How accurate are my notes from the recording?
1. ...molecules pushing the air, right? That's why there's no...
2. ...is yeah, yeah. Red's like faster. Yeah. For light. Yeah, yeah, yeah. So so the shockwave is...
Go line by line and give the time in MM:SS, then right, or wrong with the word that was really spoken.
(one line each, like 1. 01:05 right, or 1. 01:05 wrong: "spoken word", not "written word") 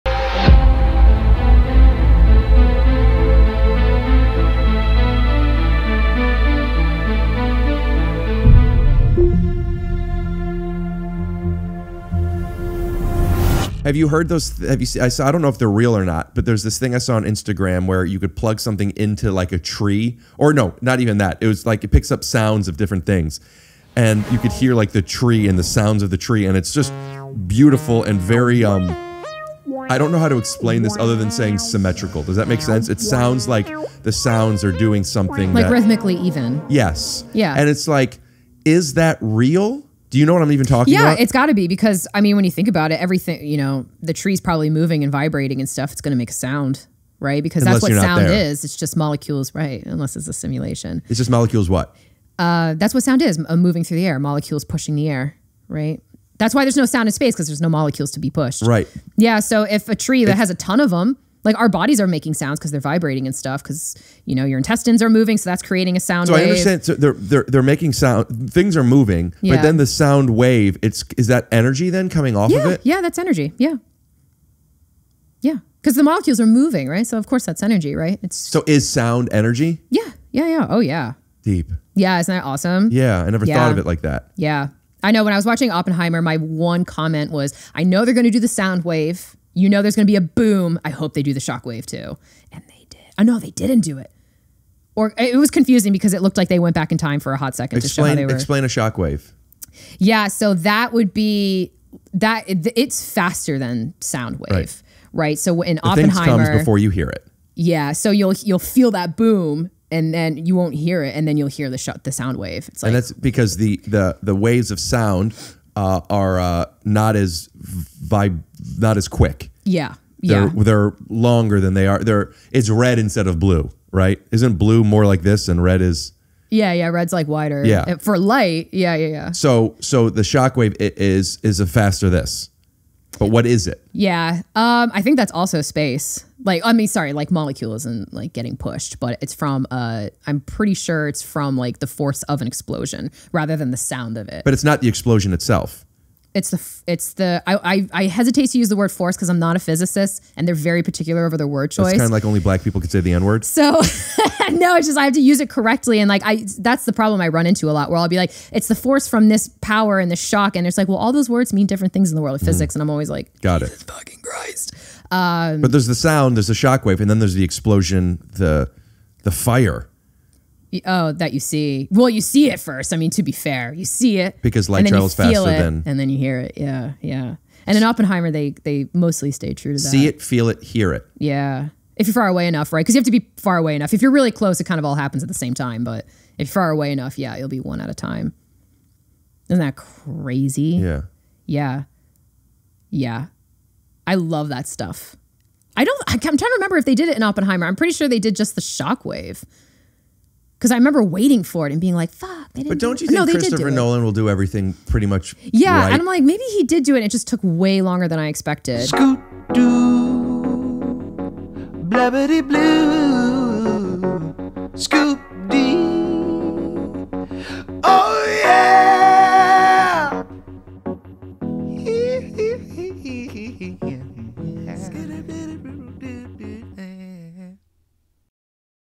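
1. 00:54 right
2. 02:05 wrong: "wider", not "faster".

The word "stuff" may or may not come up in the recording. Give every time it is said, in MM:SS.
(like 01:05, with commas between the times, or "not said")
00:45, 01:03, 03:14.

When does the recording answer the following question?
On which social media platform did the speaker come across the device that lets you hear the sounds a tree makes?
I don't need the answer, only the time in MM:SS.
00:17.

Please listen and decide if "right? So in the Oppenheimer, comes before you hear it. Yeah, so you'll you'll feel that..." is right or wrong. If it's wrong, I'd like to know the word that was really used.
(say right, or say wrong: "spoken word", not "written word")
right.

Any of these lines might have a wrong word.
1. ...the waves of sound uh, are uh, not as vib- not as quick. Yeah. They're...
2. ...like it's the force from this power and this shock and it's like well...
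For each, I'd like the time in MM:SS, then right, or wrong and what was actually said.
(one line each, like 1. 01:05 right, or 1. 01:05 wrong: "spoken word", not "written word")
1. 01:54 right
2. 02:38 right.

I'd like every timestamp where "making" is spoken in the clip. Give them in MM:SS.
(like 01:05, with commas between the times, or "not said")
01:02, 01:07.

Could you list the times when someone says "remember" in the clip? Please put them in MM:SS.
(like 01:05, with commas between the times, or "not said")
03:16, 03:20.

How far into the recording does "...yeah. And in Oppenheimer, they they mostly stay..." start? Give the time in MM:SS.
02:57.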